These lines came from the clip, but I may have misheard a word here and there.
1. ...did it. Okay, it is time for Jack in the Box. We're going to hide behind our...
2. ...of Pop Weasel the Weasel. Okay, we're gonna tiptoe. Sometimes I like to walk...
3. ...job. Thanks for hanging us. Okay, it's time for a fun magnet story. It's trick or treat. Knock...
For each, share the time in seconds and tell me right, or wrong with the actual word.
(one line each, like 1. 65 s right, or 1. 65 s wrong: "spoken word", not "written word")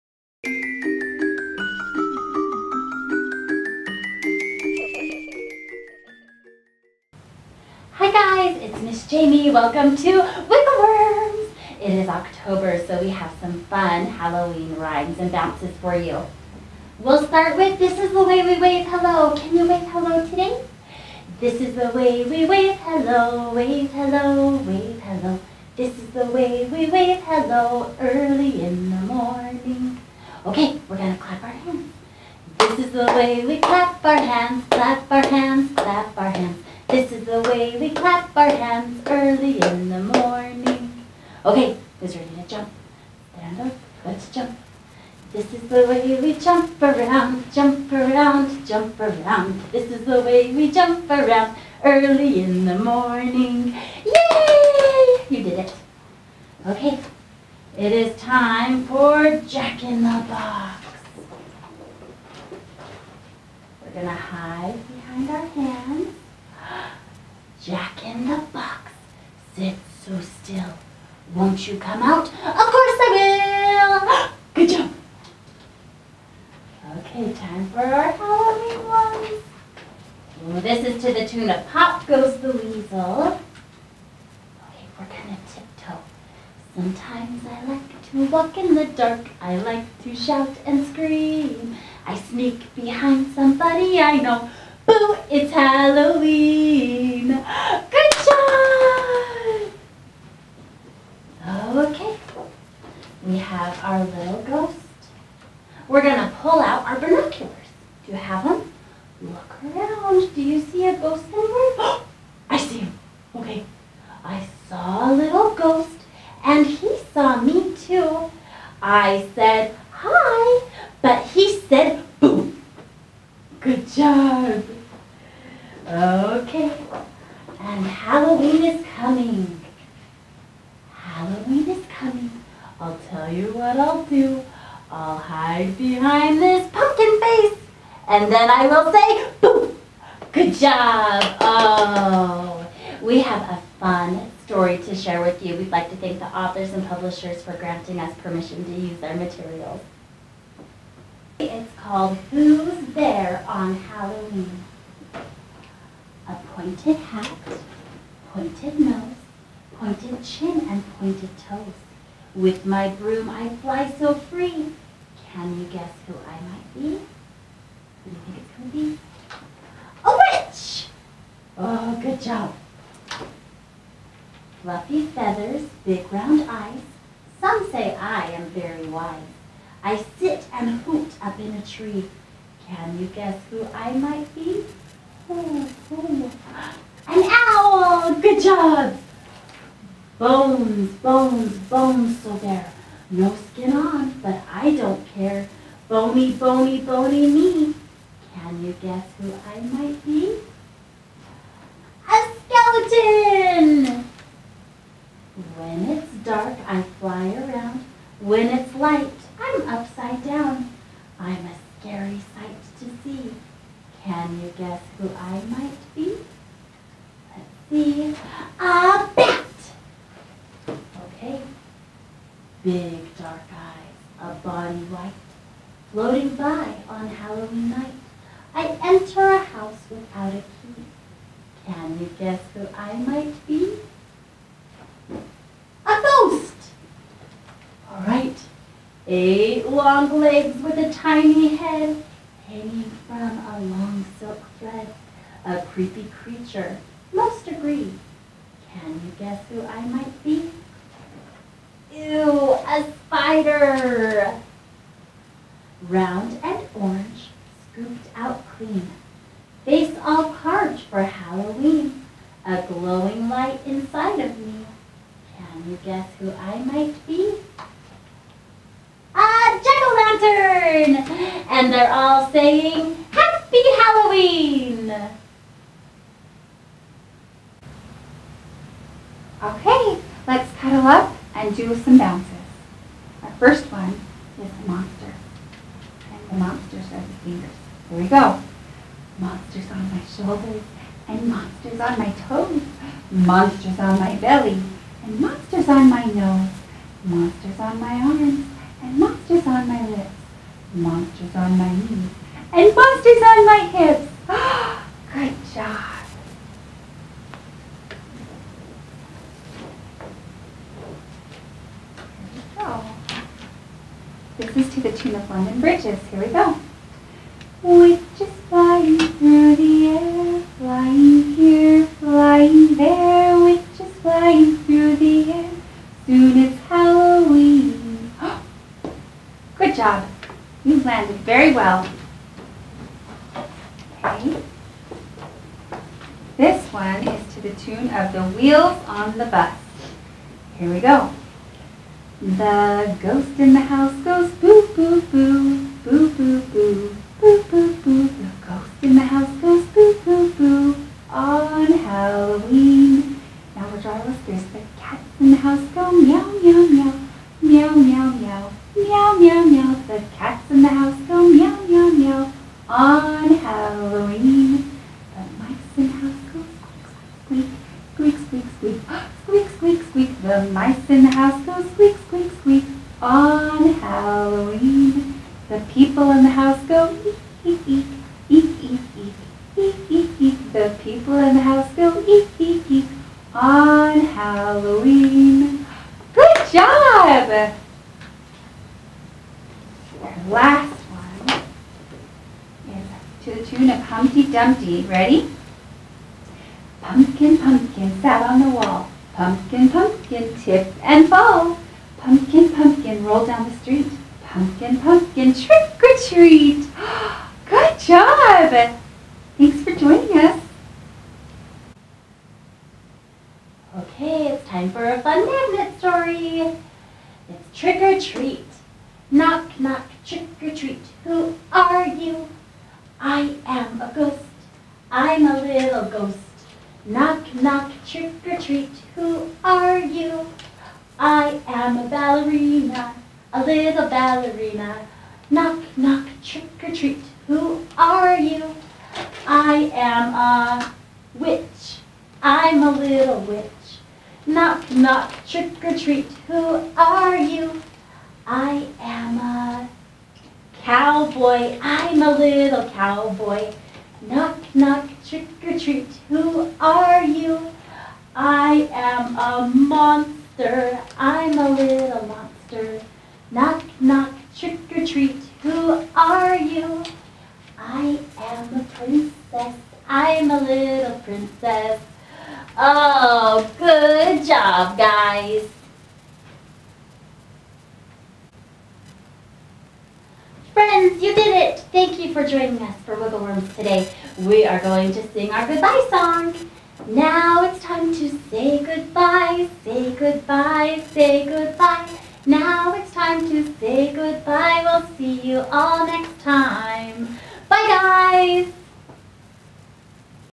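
1. 55 s right
2. 81 s wrong: "Goes", not "Weasel"
3. 407 s wrong: "joining", not "hanging".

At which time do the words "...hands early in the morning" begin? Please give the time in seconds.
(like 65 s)
38 s.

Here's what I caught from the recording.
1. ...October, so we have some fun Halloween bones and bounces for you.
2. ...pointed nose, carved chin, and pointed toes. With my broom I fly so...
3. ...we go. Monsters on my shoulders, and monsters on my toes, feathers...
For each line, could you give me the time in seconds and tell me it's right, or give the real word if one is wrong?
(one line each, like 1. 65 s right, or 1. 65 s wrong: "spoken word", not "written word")
1. 12 s wrong: "rhymes", not "bones"
2. 158 s wrong: "pointed", not "carved"
3. 287 s wrong: "monsters", not "feathers".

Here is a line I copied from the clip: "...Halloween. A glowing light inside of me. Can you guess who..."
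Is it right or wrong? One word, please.
right.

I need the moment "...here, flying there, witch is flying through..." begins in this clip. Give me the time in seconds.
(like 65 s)
321 s.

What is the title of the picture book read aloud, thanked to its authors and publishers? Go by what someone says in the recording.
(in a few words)
Who's There on Halloween?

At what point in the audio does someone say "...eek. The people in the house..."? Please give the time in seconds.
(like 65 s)
380 s.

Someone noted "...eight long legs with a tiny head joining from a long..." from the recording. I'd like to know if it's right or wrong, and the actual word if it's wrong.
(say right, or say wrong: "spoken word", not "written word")
wrong: "hanging", not "joining".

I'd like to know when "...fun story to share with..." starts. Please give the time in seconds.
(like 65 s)
143 s.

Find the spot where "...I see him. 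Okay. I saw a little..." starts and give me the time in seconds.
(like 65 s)
112 s.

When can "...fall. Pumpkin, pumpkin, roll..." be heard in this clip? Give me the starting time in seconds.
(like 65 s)
401 s.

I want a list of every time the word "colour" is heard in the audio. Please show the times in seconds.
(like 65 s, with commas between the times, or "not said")
not said.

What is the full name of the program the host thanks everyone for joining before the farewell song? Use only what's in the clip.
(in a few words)
Wiggle Worms.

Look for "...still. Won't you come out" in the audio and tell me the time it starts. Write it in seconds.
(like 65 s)
70 s.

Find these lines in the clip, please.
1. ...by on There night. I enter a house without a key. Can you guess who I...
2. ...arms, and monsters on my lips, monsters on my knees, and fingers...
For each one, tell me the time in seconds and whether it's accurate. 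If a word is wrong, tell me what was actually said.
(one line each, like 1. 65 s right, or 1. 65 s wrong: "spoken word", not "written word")
1. 226 s wrong: "Halloween", not "There"
2. 298 s wrong: "monsters", not "fingers".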